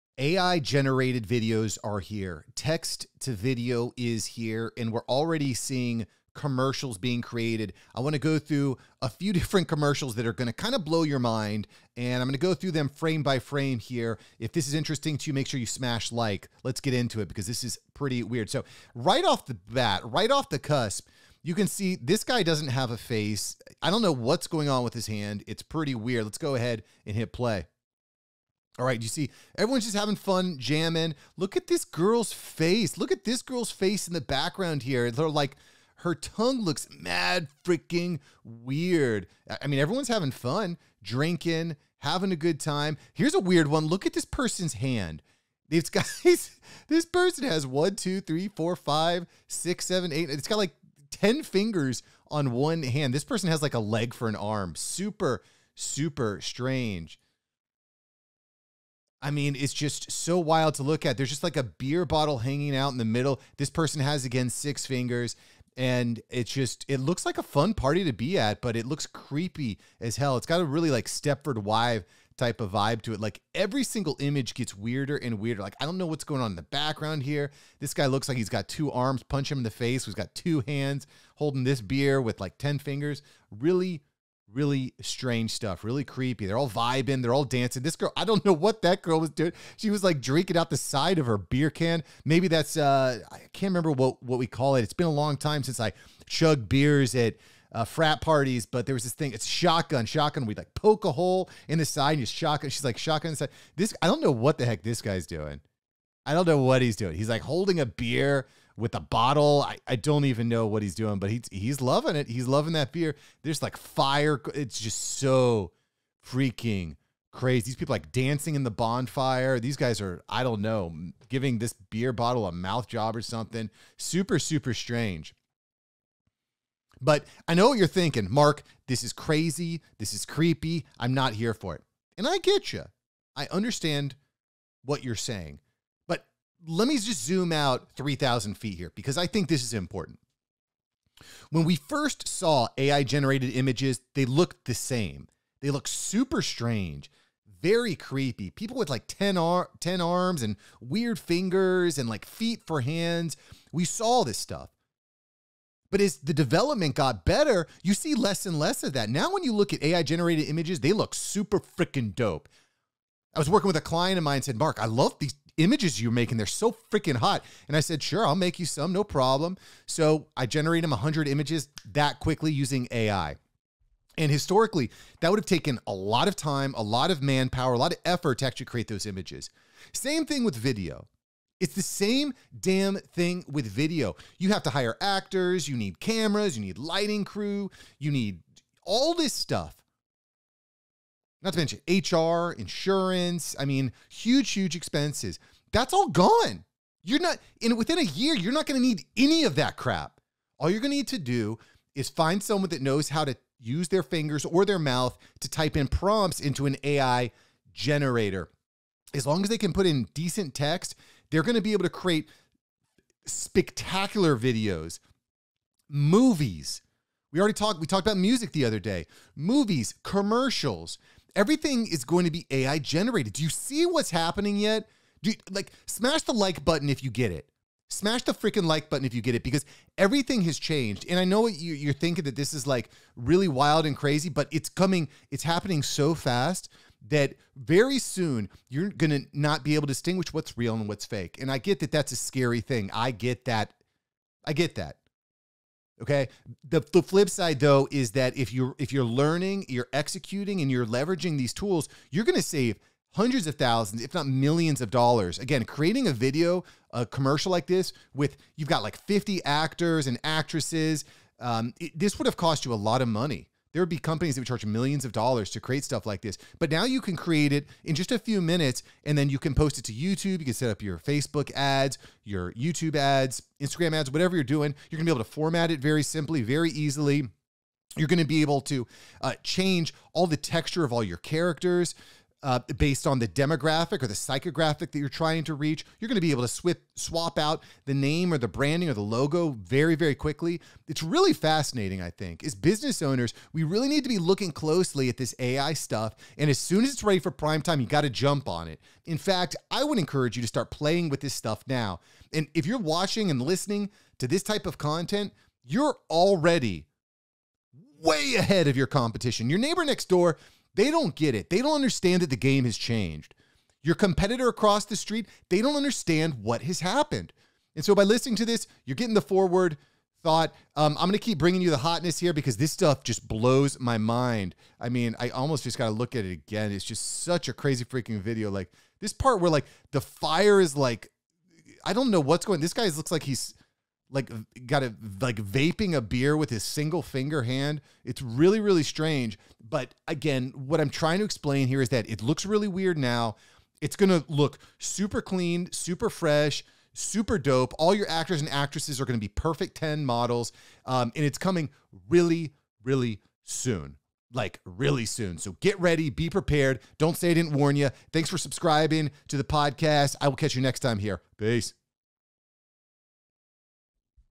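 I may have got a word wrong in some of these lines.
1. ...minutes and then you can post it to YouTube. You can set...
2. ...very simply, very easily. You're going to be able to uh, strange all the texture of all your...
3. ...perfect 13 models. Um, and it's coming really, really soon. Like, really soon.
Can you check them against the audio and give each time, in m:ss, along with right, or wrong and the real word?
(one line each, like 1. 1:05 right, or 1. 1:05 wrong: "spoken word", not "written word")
1. 4:28 right
2. 4:35 wrong: "change", not "strange"
3. 5:49 wrong: "10", not "13".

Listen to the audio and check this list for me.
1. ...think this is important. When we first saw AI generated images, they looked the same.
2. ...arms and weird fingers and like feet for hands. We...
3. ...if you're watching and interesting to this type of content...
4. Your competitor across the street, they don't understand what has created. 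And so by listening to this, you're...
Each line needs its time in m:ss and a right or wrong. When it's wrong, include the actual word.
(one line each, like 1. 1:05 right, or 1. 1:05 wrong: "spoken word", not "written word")
1. 2:19 right
2. 2:30 right
3. 5:02 wrong: "listening", not "interesting"
4. 5:13 wrong: "happened", not "created".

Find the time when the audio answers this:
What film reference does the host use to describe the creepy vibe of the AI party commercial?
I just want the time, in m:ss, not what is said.
1:11.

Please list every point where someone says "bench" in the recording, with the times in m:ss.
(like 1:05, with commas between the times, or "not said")
not said.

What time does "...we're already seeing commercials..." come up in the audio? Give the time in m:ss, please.
0:04.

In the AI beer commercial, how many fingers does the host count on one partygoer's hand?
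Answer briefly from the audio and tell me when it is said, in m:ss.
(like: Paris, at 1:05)
10, at 0:50.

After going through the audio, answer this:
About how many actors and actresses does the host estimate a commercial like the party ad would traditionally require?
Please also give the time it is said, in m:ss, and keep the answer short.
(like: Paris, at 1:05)
50, at 4:19.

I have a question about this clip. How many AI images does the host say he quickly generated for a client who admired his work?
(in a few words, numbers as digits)
100.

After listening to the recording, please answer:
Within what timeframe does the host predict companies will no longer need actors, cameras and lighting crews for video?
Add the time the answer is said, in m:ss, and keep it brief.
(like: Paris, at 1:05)
Within a year, at 3:17.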